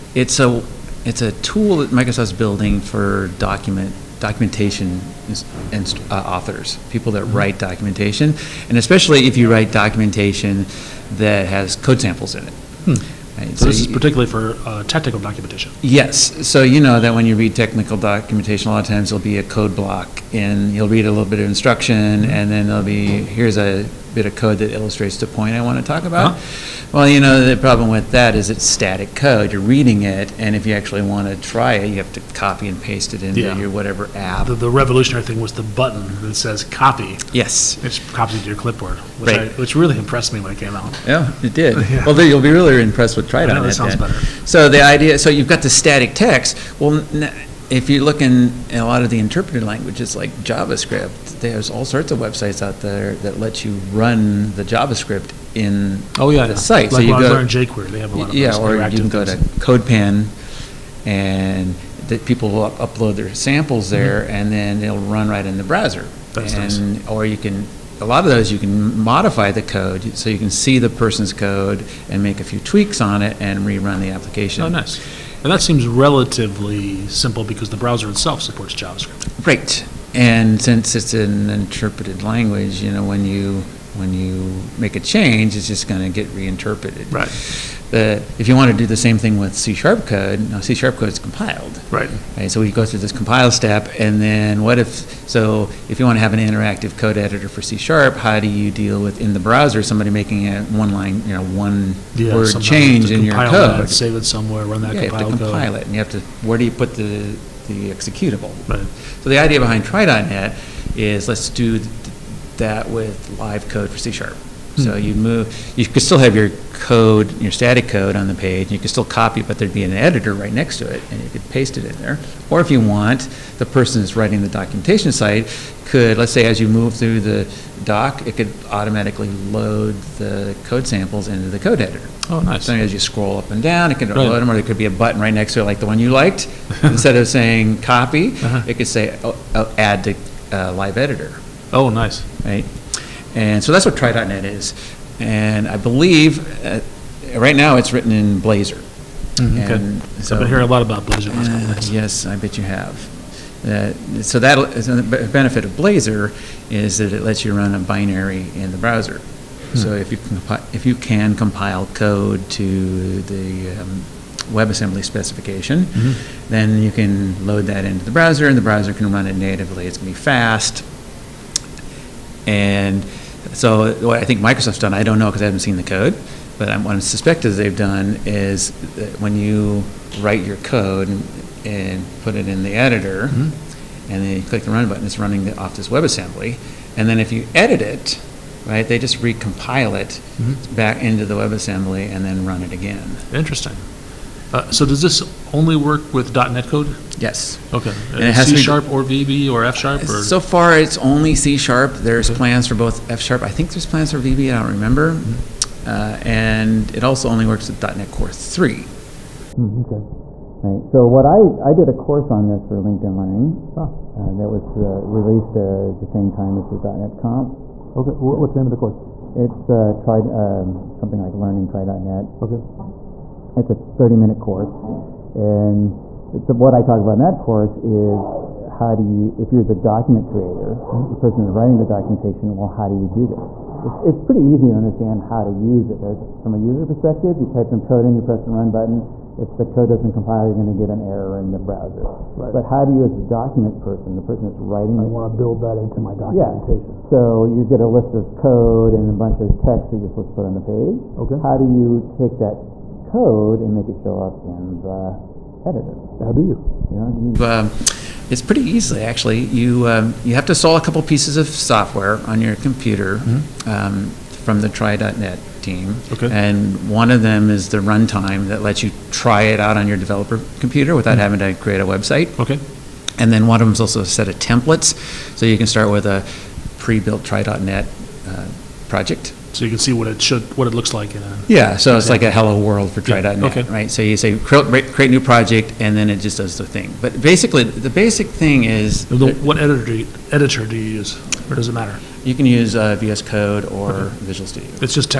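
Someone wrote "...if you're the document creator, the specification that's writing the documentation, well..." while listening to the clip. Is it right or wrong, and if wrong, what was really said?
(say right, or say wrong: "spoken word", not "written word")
wrong: "person", not "specification".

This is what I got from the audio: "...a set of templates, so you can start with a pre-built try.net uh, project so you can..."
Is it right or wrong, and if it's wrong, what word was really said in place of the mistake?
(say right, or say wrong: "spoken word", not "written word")
right.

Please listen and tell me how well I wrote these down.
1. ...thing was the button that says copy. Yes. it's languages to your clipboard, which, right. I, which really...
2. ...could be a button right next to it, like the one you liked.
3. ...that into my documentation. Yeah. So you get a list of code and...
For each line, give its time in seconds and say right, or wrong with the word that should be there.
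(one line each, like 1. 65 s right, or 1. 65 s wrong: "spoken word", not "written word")
1. 35 s wrong: "copies", not "languages"
2. 134 s right
3. 245 s right.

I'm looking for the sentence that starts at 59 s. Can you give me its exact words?
to CodePen, and that people will up upload their samples mm-hmm.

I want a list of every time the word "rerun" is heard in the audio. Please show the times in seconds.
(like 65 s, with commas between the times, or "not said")
73 s.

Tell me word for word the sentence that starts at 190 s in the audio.
back into the WebAssembly and then run it again.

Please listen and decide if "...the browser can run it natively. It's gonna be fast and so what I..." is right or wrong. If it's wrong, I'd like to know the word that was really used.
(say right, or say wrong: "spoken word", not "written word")
right.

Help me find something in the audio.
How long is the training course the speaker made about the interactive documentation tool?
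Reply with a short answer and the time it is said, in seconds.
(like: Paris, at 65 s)
30 minutes, at 223 s.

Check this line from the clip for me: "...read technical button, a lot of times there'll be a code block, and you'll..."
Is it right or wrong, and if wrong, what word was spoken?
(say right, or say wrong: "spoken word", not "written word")
wrong: "documentation", not "button".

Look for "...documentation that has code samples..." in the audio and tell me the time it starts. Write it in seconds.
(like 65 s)
9 s.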